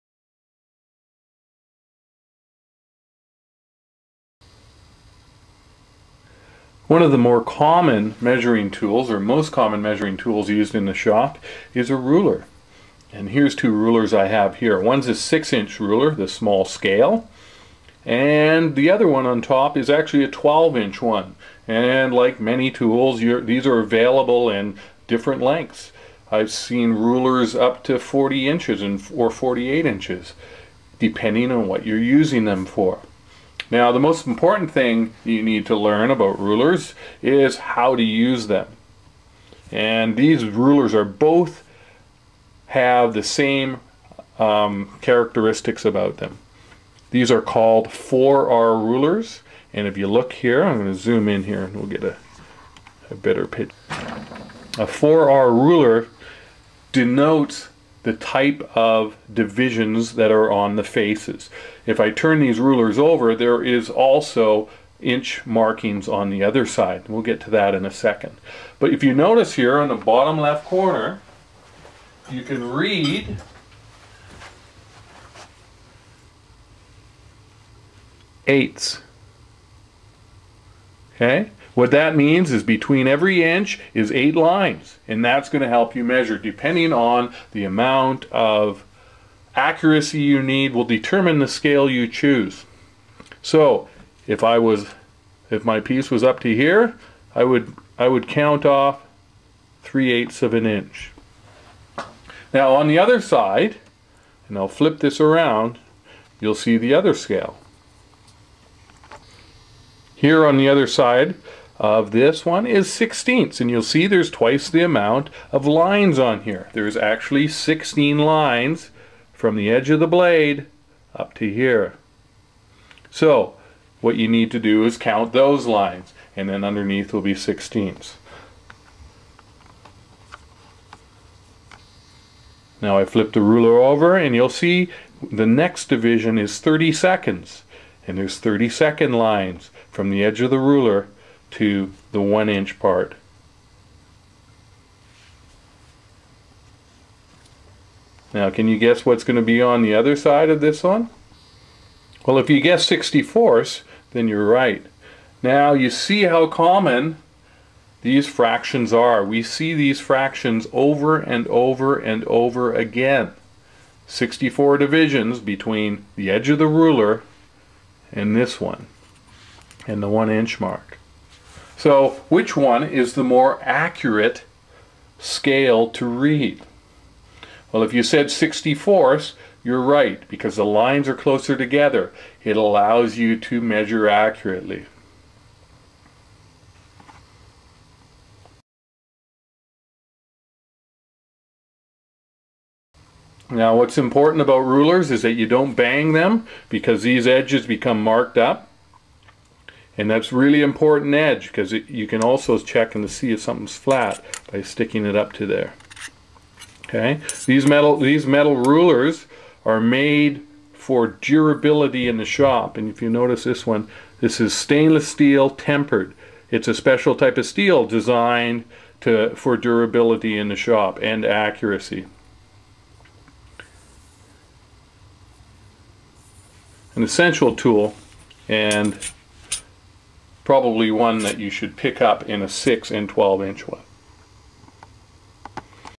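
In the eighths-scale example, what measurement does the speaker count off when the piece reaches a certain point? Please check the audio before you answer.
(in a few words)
3/8 of an inch.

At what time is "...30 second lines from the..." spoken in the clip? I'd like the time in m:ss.
2:18.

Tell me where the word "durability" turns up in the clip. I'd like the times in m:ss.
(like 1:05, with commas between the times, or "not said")
3:31, 3:39.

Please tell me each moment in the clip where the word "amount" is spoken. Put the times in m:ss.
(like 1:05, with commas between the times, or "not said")
1:27, 1:54.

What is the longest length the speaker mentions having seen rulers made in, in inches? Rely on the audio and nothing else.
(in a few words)
48 inches.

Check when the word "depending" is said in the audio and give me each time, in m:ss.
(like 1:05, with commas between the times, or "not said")
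0:30, 1:26.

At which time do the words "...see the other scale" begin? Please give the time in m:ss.
1:46.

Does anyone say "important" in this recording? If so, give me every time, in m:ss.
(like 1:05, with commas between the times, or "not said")
0:34, 3:13, 3:20.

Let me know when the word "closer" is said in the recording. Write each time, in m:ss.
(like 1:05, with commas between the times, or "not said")
3:01.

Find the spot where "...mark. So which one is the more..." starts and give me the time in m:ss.
2:50.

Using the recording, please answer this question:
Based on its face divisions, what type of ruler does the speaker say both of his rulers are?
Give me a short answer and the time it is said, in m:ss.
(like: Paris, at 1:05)
4R rulers, at 0:47.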